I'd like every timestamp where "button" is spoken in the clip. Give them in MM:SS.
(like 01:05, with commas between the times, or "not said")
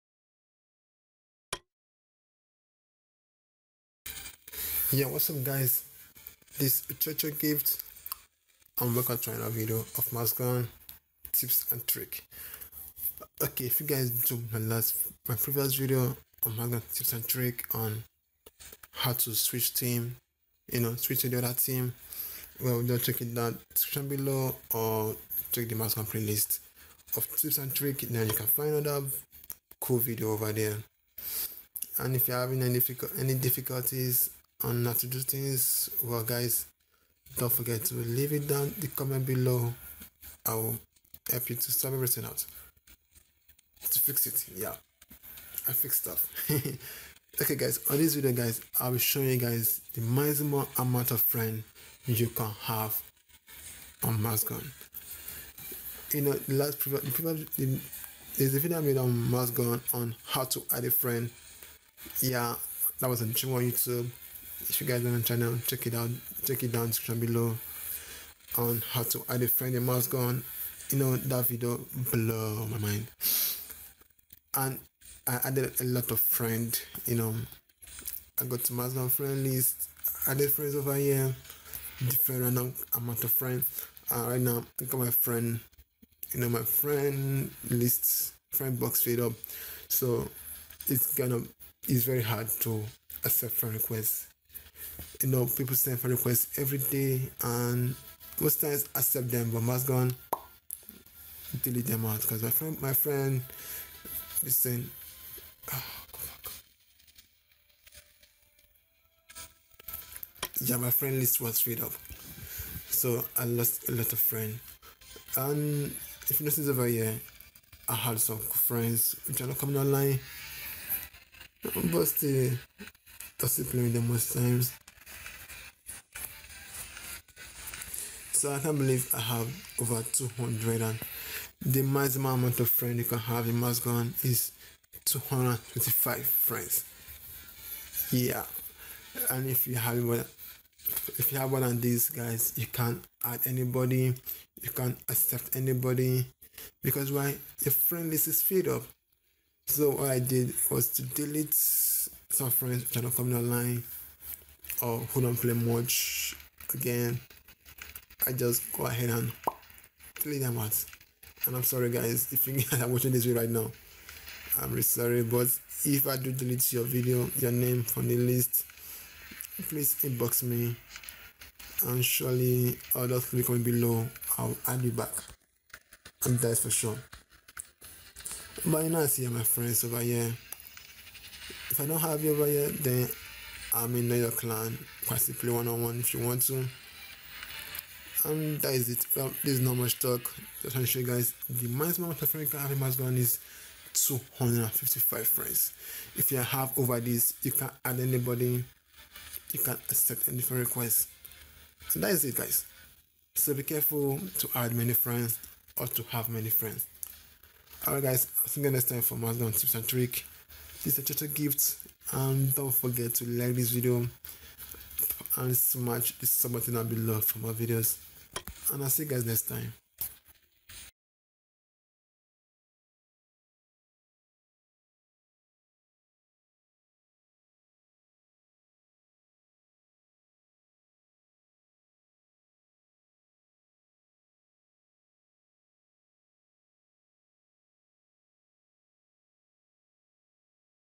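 03:36.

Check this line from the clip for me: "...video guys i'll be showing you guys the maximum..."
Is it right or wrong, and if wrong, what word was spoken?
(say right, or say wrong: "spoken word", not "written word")
right.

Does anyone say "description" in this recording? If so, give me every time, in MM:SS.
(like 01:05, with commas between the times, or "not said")
00:23, 01:06.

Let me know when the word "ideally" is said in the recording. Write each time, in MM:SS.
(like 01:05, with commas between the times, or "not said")
not said.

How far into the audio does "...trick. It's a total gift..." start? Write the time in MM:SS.
03:29.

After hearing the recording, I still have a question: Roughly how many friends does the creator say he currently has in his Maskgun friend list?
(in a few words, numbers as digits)
Over 200.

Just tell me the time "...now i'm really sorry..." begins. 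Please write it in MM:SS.
02:43.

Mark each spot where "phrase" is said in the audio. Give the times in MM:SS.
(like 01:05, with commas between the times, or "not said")
not said.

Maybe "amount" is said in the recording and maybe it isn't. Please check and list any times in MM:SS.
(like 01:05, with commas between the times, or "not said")
00:50, 01:22, 02:12, 03:12.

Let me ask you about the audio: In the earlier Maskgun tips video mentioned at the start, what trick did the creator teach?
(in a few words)
Switch team.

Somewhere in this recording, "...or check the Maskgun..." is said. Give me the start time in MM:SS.
00:24.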